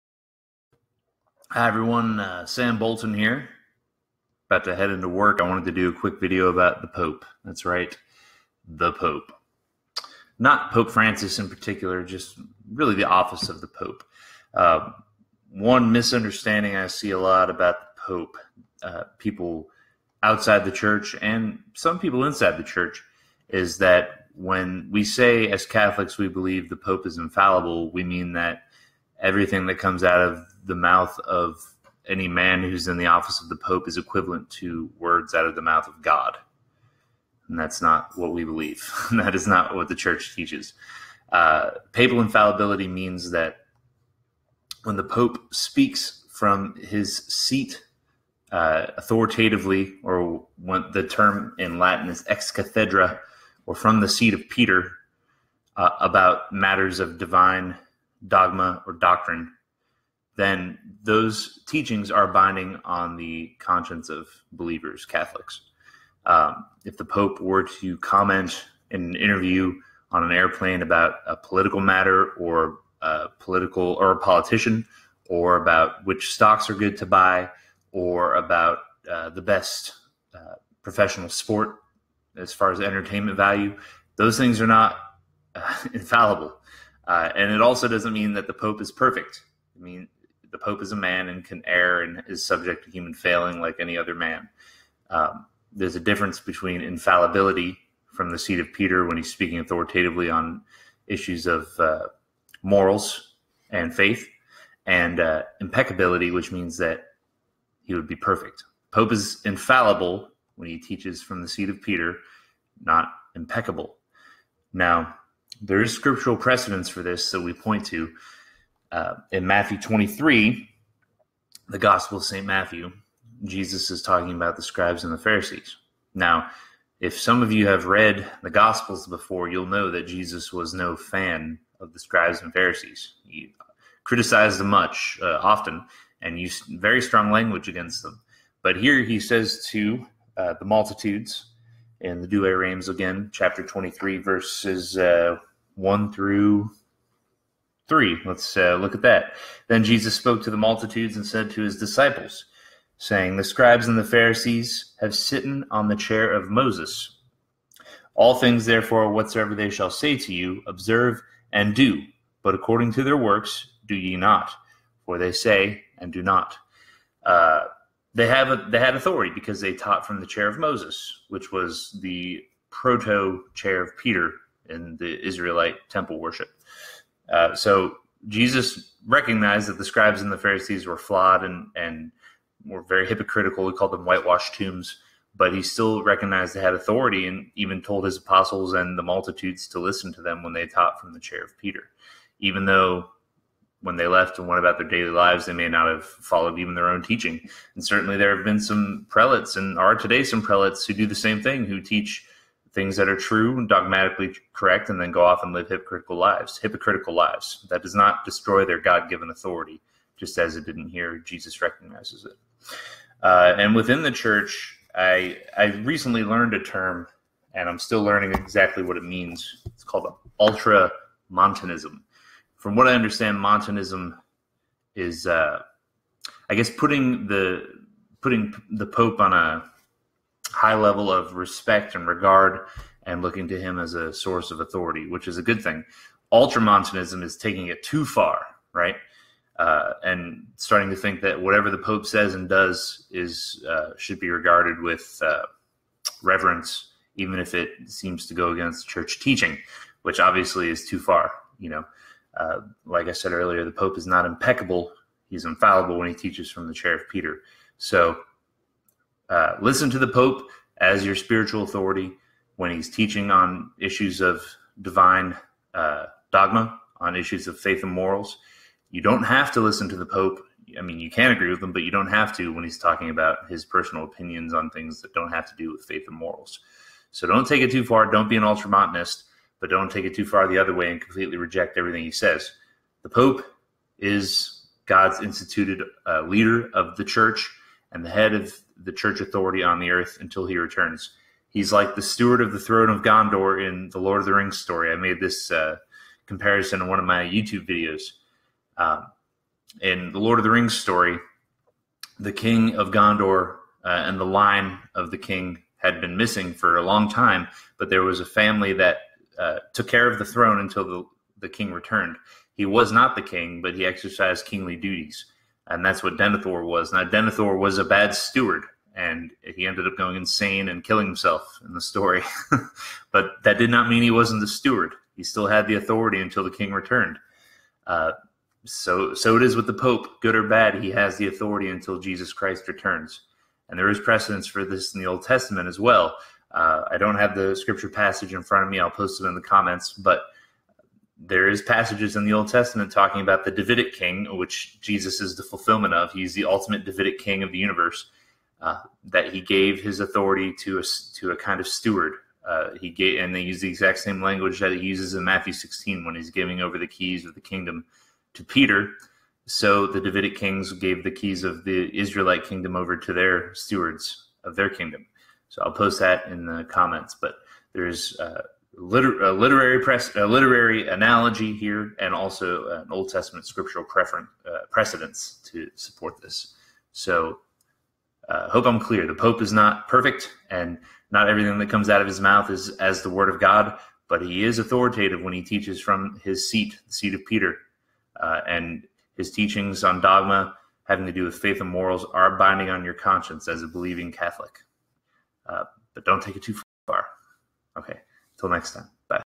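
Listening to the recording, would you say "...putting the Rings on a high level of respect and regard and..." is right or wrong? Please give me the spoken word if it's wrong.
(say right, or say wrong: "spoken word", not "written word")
wrong: "Pope", not "Rings".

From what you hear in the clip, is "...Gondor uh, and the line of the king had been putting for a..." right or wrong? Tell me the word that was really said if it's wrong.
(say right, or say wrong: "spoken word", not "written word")
wrong: "missing", not "putting".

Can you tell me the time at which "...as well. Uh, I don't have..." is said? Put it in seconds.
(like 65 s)
335 s.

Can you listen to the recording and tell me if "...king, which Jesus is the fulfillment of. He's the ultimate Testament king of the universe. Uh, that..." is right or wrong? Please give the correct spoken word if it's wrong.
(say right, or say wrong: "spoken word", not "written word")
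wrong: "Davidic", not "Testament".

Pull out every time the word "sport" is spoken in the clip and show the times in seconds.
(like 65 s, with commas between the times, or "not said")
81 s.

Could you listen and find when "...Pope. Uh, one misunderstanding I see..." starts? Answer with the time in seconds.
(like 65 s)
13 s.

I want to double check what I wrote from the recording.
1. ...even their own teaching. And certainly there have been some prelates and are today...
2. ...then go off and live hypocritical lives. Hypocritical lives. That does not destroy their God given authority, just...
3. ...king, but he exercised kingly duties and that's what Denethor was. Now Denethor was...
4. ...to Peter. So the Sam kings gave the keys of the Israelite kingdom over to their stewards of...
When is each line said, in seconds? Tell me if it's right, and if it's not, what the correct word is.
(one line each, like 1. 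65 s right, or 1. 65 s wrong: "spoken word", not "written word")
1. 196 s right
2. 205 s right
3. 313 s right
4. 358 s wrong: "Davidic", not "Sam".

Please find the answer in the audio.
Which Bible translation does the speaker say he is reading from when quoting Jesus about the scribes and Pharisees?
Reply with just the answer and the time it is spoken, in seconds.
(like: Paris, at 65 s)
Douay-Rheims, at 142 s.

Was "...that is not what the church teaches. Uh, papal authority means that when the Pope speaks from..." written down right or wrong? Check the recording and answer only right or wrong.
wrong.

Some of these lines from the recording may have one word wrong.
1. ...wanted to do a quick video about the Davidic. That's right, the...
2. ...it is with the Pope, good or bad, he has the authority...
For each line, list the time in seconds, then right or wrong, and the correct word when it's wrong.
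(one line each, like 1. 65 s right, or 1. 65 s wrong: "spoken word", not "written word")
1. 5 s wrong: "Pope", not "Davidic"
2. 329 s right.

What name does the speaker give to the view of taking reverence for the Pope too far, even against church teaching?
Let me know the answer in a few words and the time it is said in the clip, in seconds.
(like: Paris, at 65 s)
Ultramontanism, at 236 s.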